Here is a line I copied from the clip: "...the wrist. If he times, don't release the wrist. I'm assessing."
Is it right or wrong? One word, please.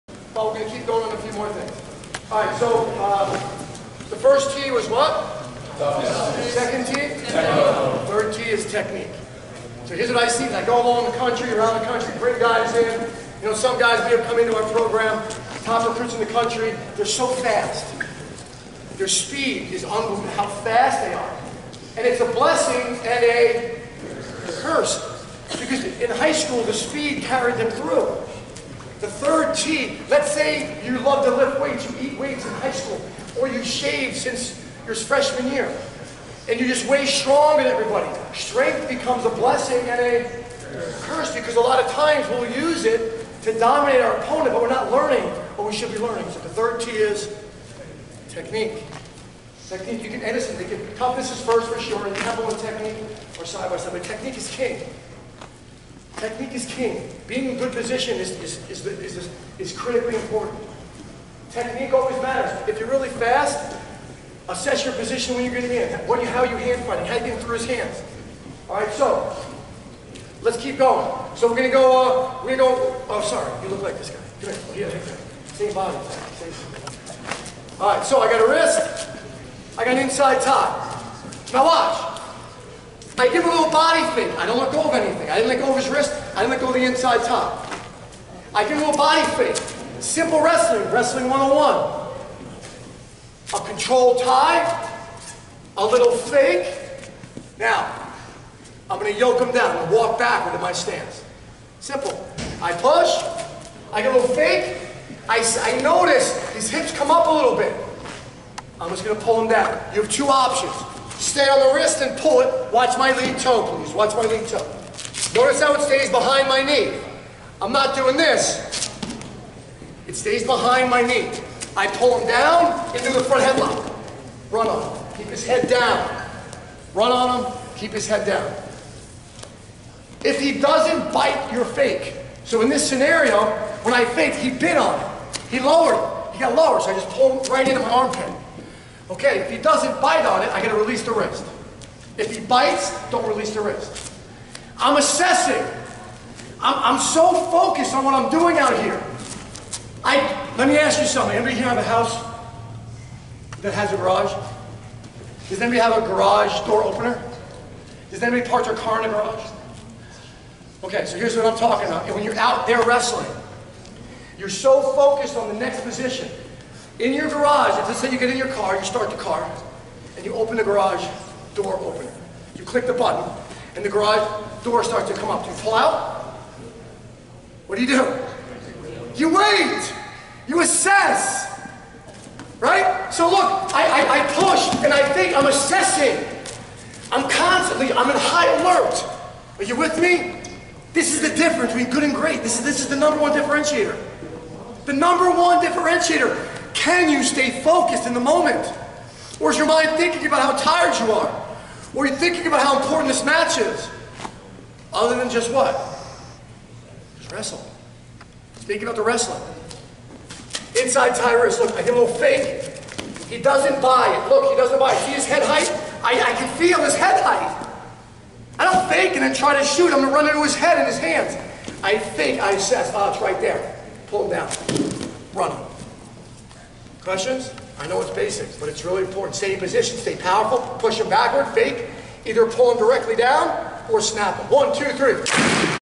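wrong.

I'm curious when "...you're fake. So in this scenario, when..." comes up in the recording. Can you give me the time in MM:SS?
02:11.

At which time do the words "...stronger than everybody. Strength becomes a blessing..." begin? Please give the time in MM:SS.
00:37.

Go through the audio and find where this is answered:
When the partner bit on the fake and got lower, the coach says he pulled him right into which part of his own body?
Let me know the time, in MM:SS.
02:17.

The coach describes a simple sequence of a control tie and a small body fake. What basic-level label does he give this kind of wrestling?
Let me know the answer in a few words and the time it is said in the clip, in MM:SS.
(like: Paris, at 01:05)
Wrestling 101, at 01:30.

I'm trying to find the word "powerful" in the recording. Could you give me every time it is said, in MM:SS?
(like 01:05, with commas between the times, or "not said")
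03:50.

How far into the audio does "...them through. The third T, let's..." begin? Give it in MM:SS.
00:27.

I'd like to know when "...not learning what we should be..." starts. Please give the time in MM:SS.
00:44.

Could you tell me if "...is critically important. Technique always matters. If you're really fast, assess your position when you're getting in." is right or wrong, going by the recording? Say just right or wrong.
right.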